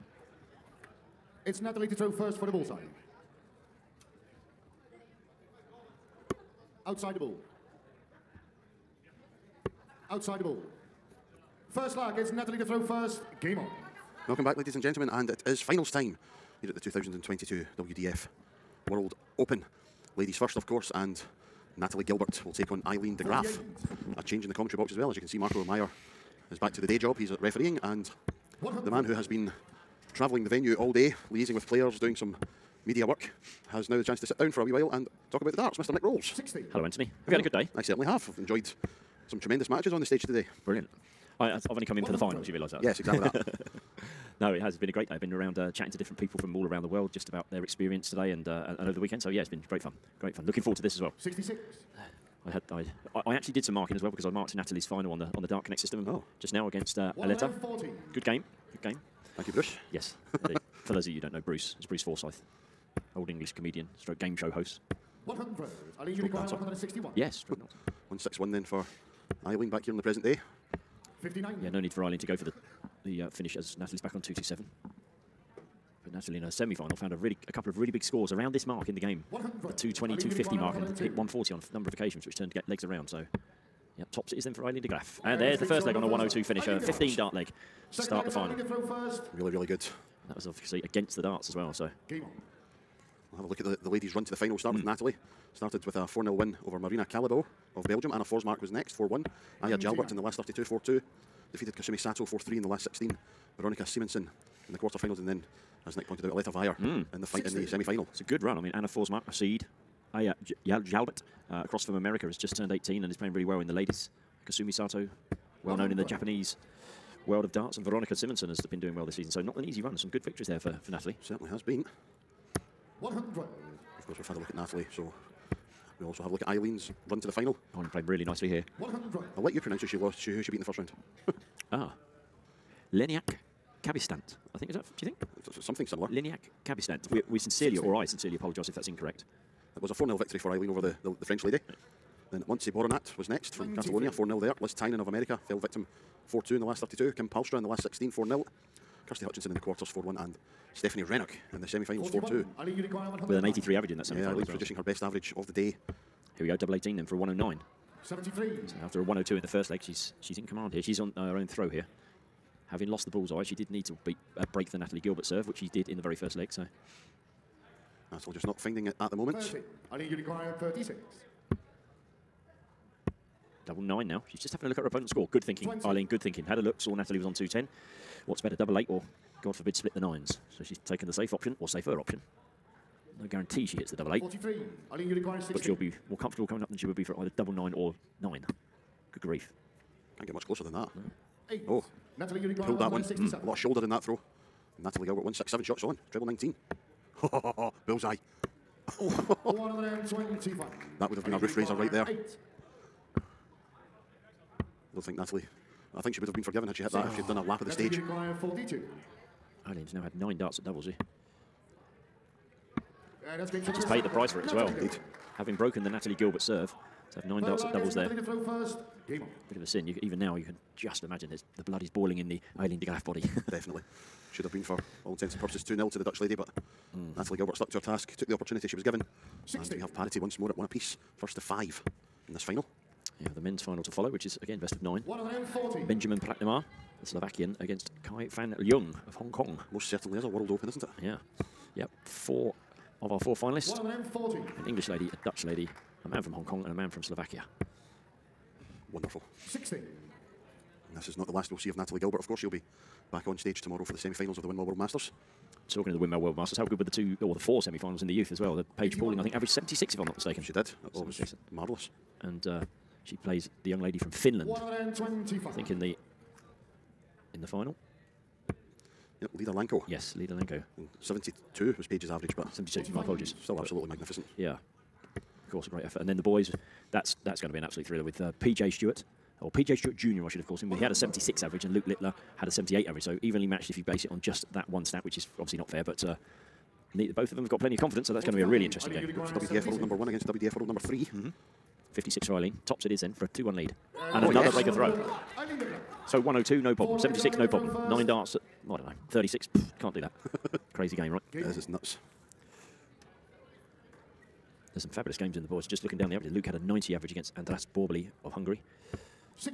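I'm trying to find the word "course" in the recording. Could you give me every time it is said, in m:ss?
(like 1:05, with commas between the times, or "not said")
0:20, 2:04, 4:12, 4:35.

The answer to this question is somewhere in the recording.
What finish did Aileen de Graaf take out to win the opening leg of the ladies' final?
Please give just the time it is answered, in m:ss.
1:26.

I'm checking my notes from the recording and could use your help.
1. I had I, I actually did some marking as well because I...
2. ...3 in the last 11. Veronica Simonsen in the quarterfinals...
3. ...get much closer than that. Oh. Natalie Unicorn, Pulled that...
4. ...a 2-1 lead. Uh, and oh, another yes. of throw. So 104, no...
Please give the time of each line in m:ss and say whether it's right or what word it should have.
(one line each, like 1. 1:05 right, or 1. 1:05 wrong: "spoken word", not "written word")
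1. 0:52 right
2. 1:42 wrong: "16", not "11"
3. 3:10 right
4. 4:53 wrong: "102", not "104".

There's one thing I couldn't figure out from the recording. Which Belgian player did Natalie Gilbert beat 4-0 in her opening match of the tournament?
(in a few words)
Marina Calibau.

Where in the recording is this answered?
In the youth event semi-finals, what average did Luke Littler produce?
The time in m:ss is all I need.
4:42.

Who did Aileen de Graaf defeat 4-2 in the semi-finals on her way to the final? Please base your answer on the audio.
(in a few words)
Stephanie Rennock.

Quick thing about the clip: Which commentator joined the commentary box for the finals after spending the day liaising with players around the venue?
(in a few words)
Nick Rolls.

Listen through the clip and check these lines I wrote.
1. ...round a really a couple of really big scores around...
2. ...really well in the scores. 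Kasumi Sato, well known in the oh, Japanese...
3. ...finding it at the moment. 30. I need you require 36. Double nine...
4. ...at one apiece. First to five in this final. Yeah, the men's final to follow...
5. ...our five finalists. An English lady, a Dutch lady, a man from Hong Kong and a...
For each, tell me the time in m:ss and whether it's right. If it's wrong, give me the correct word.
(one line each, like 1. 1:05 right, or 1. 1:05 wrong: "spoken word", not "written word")
1. 1:16 wrong: "found", not "round"
2. 1:53 wrong: "ladies", not "scores"
3. 2:48 right
4. 3:50 right
5. 4:03 wrong: "four", not "five".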